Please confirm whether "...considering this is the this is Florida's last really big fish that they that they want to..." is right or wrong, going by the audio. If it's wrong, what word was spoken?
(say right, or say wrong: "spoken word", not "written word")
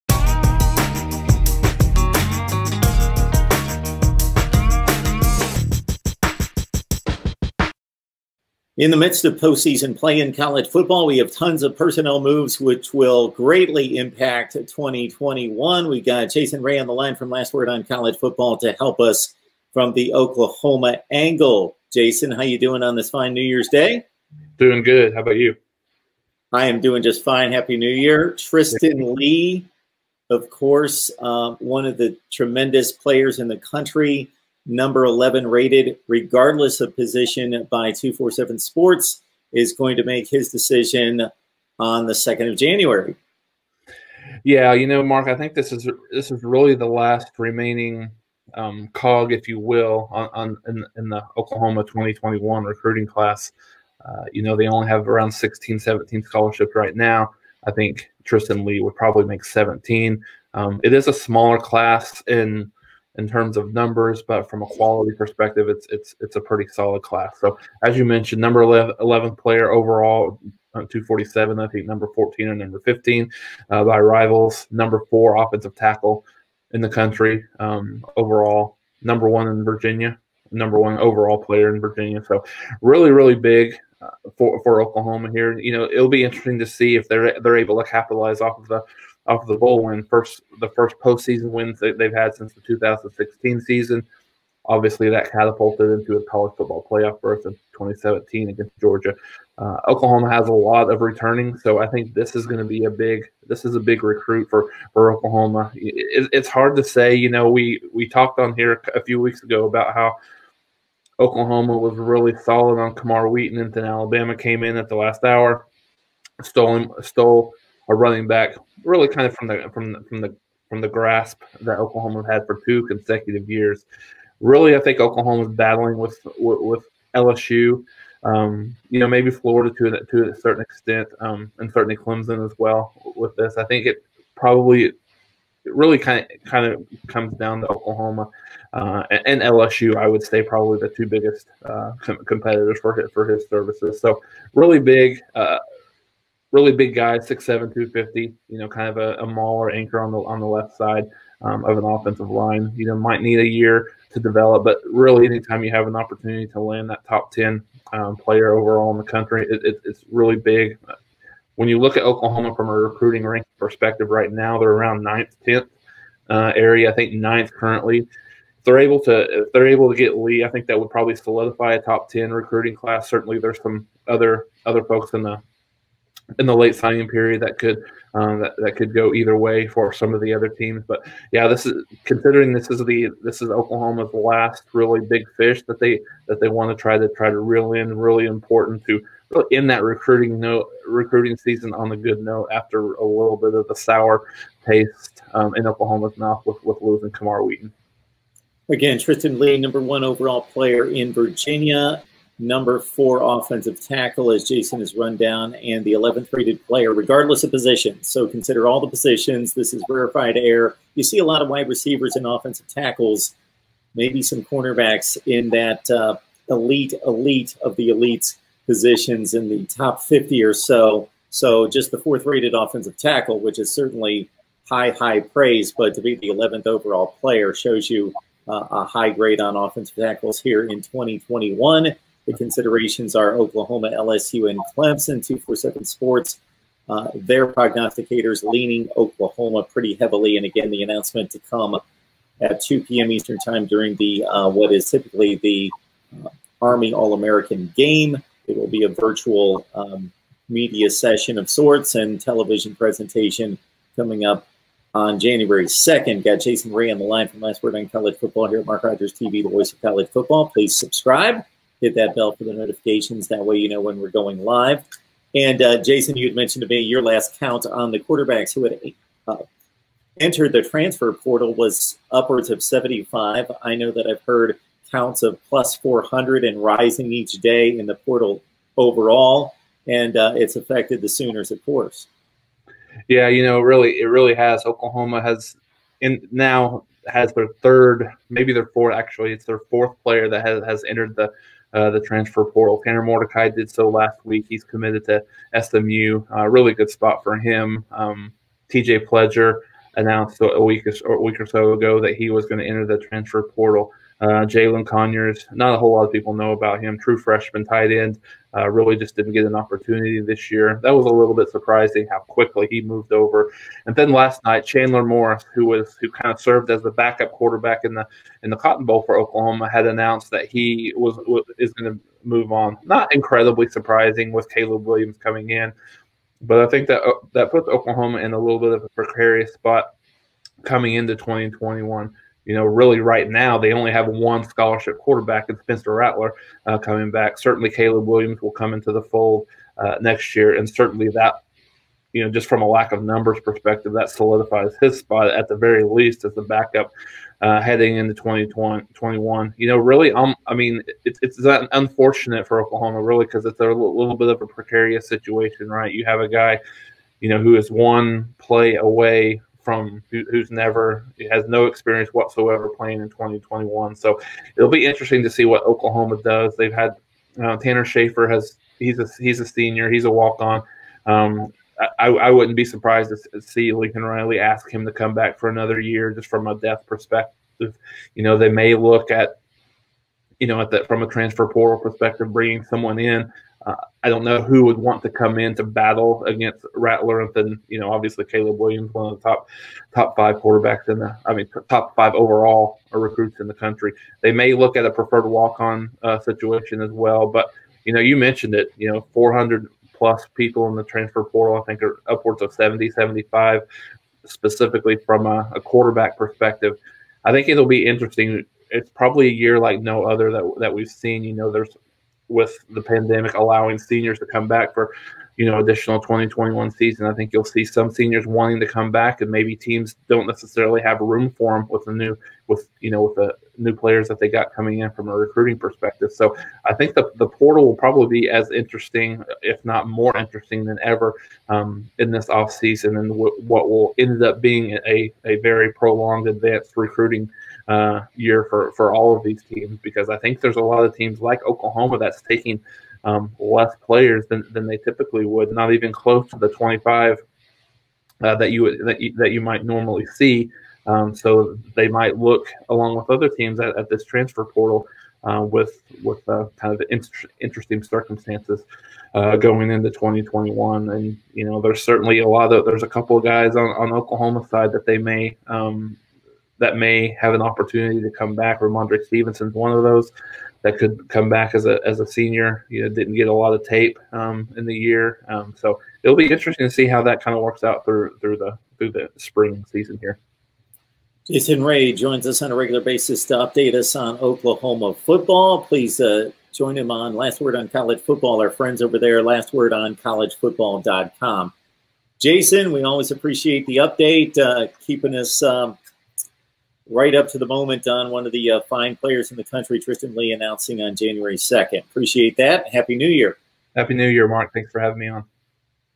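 wrong: "Oklahoma", not "Florida".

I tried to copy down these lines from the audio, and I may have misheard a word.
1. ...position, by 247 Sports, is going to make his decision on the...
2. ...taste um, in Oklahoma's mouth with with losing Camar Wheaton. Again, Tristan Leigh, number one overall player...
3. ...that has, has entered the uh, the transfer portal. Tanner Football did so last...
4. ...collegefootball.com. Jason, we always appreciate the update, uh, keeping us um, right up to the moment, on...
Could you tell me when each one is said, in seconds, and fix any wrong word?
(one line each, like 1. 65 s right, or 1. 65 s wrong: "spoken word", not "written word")
1. 36 s right
2. 194 s right
3. 290 s wrong: "Mordecai", not "Football"
4. 489 s right.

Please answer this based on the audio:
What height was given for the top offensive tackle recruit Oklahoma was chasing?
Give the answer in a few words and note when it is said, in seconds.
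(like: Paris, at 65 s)
6'7", at 147 s.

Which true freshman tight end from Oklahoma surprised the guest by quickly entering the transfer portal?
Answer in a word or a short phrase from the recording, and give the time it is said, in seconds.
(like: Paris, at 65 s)
Jalin Conyers, at 304 s.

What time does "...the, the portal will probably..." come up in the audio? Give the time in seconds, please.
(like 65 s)
426 s.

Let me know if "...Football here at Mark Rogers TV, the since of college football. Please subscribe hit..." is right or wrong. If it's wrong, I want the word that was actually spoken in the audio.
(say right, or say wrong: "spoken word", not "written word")
wrong: "voice", not "since".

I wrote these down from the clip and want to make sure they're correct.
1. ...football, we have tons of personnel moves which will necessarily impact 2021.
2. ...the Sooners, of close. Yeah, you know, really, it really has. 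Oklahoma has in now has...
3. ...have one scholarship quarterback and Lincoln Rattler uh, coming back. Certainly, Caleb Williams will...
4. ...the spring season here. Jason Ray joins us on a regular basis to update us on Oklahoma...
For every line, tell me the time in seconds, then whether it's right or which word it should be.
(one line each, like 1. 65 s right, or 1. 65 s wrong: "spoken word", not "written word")
1. 10 s wrong: "greatly", not "necessarily"
2. 281 s wrong: "course", not "close"
3. 333 s wrong: "Spencer", not "Lincoln"
4. 478 s right.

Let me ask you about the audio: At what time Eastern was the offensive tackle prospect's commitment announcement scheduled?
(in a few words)
2 p.m.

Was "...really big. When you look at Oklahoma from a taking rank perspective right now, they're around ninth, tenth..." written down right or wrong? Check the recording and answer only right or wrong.
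wrong.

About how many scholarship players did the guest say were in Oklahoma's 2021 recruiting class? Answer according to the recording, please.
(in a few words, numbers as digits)
16, 17.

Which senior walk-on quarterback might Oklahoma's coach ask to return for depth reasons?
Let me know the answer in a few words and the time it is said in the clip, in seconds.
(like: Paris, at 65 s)
Tanner Schaefer, at 367 s.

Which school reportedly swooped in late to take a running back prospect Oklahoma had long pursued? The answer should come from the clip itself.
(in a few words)
Alabama.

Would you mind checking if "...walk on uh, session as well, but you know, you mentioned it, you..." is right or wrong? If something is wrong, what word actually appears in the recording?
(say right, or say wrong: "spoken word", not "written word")
wrong: "situation", not "session".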